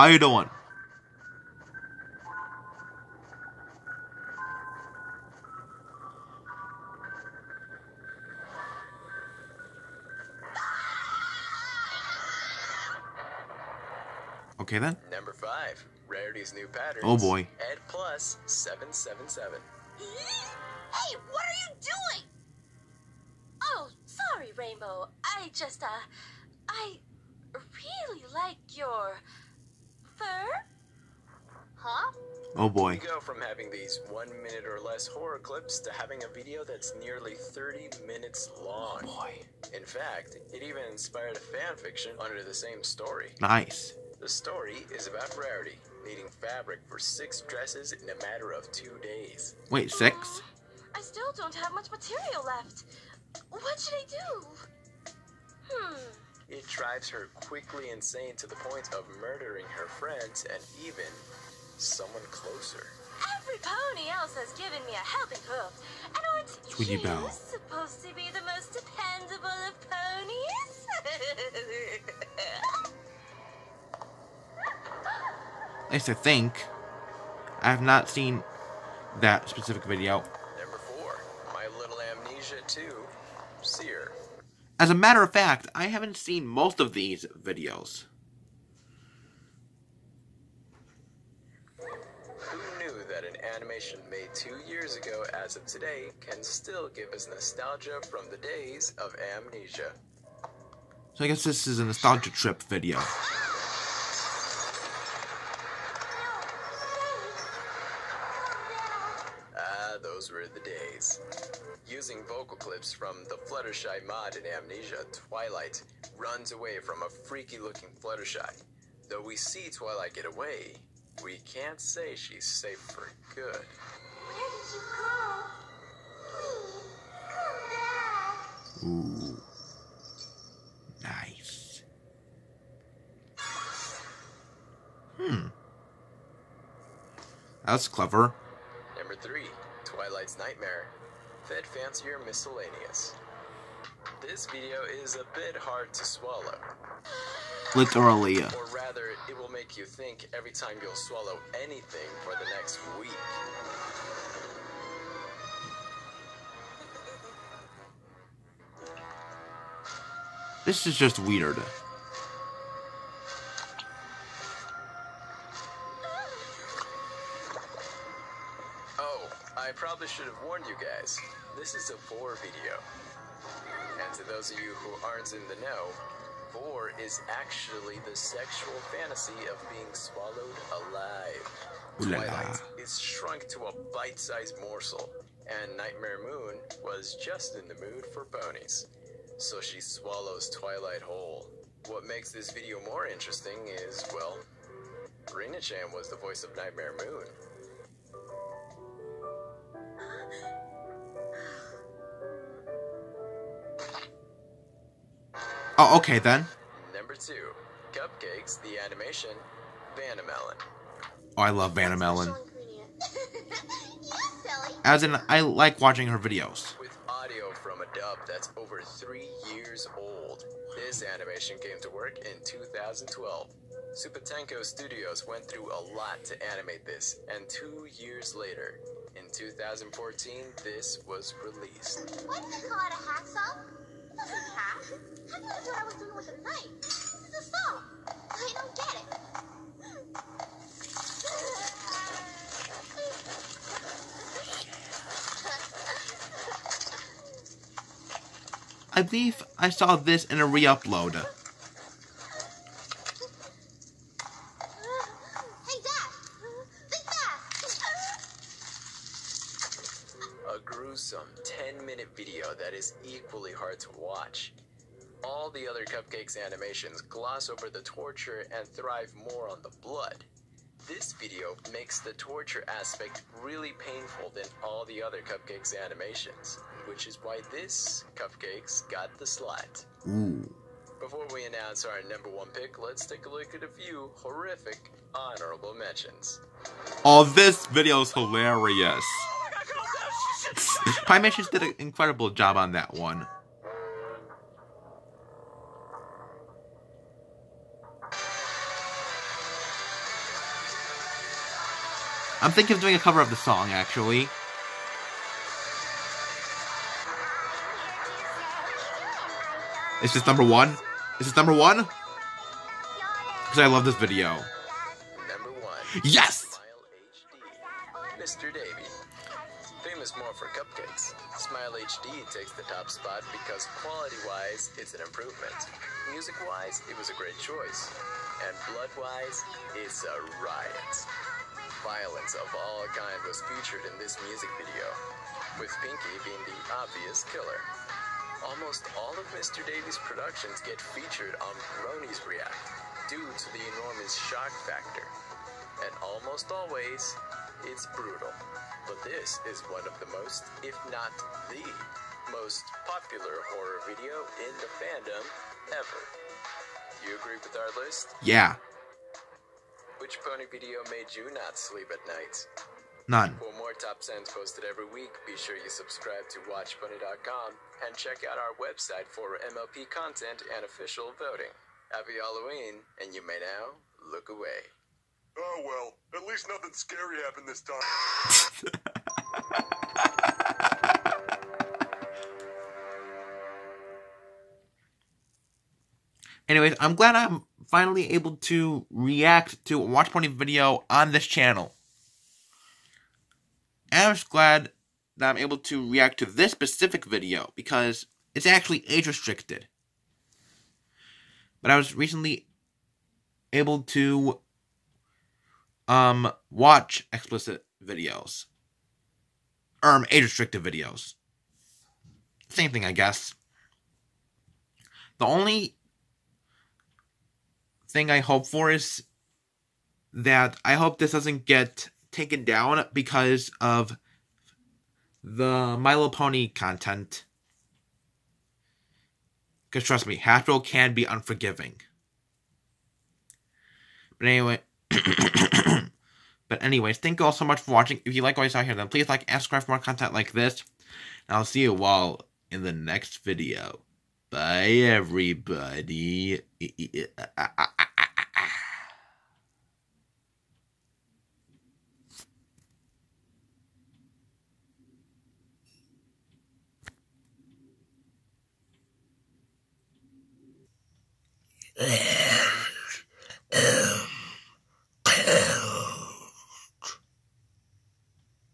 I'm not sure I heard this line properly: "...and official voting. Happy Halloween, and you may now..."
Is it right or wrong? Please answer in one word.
right.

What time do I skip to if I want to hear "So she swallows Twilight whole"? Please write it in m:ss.
3:09.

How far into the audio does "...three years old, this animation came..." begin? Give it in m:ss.
3:38.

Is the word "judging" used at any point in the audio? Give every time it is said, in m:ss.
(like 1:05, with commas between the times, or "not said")
not said.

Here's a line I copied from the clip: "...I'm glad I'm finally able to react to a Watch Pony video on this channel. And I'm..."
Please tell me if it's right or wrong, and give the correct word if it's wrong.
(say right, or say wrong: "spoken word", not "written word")
right.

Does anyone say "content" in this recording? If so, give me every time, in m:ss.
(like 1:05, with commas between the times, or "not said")
6:09, 7:06, 7:19.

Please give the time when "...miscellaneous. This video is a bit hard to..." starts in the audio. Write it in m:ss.
2:22.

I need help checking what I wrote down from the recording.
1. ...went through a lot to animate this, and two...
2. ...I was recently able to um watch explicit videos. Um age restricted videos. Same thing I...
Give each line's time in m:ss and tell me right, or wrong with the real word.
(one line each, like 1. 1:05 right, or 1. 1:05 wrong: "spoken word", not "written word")
1. 3:45 right
2. 6:41 right.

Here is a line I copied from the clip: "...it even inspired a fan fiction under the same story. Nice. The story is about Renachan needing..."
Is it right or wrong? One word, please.
wrong.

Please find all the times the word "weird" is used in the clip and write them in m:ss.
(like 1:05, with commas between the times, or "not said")
2:41.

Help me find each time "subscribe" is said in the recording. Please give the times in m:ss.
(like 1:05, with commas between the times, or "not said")
6:05, 7:19.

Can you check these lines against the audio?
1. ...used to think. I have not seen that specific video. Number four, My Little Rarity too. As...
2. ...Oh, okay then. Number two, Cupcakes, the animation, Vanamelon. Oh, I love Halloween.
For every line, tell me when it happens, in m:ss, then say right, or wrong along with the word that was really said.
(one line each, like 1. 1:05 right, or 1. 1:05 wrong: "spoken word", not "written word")
1. 1:15 wrong: "Amnesia", not "Rarity"
2. 3:25 wrong: "Vanamelon", not "Halloween".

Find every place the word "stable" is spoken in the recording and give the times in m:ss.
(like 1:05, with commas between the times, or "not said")
not said.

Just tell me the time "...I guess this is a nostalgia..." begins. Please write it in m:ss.
1:41.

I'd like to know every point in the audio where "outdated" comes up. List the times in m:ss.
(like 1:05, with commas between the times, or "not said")
not said.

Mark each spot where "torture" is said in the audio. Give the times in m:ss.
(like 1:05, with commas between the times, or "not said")
4:27, 4:32.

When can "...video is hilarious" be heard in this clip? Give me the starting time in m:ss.
4:47.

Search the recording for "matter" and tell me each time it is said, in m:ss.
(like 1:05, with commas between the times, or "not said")
0:48, 1:24.